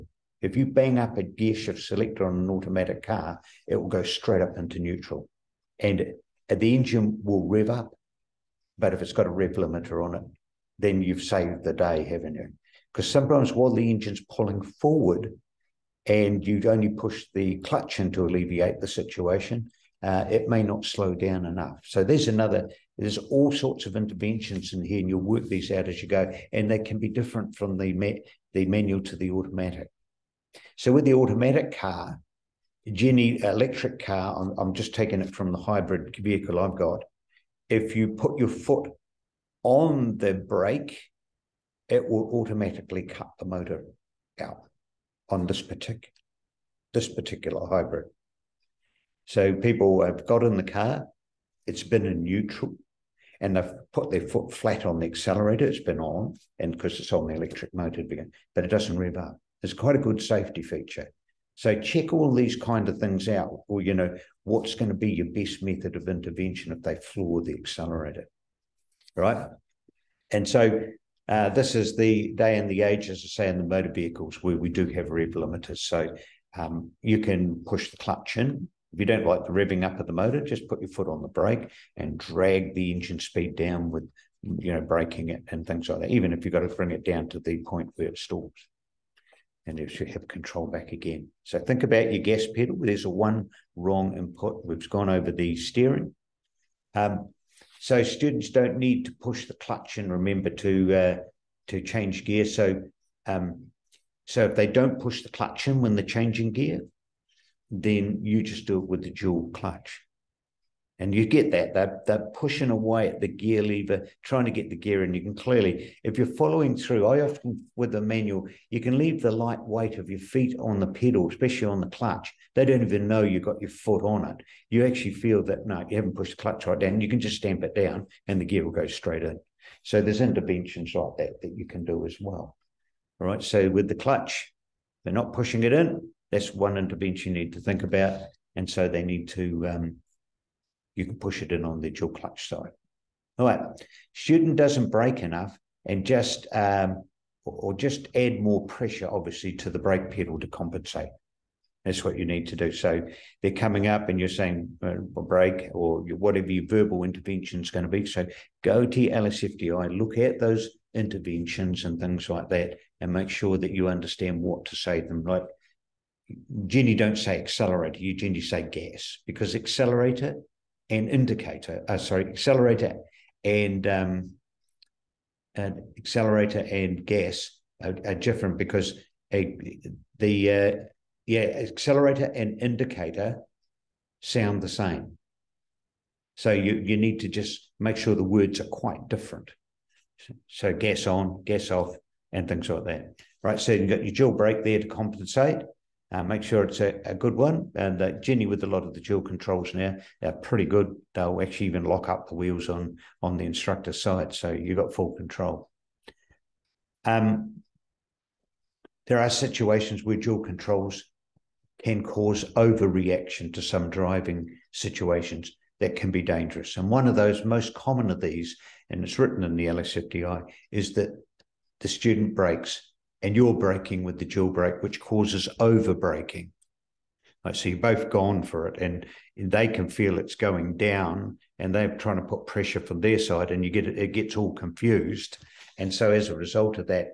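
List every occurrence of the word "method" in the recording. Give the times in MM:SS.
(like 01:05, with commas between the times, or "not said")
01:05.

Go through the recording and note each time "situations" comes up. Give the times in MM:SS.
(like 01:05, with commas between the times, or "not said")
00:18, 03:29, 03:34.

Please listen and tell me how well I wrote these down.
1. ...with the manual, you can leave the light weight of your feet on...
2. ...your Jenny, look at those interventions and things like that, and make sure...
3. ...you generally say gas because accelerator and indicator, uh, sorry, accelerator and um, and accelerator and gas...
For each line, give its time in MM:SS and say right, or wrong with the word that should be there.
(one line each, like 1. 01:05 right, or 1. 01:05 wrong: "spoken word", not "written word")
1. 01:57 right
2. 02:39 wrong: "LSFDI", not "Jenny"
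3. 02:47 right.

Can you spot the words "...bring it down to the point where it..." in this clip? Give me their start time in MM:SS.
01:26.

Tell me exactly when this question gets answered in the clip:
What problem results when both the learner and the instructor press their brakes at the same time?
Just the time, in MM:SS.
03:45.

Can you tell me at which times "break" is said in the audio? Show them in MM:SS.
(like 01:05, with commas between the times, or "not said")
02:24, 02:35.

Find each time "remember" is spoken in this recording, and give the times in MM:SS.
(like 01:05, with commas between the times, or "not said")
01:40.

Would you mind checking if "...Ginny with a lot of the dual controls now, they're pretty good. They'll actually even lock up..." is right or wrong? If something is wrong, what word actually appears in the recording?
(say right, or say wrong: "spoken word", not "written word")
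right.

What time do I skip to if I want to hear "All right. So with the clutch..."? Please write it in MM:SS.
02:13.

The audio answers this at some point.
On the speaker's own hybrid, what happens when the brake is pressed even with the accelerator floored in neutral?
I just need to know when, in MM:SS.
00:43.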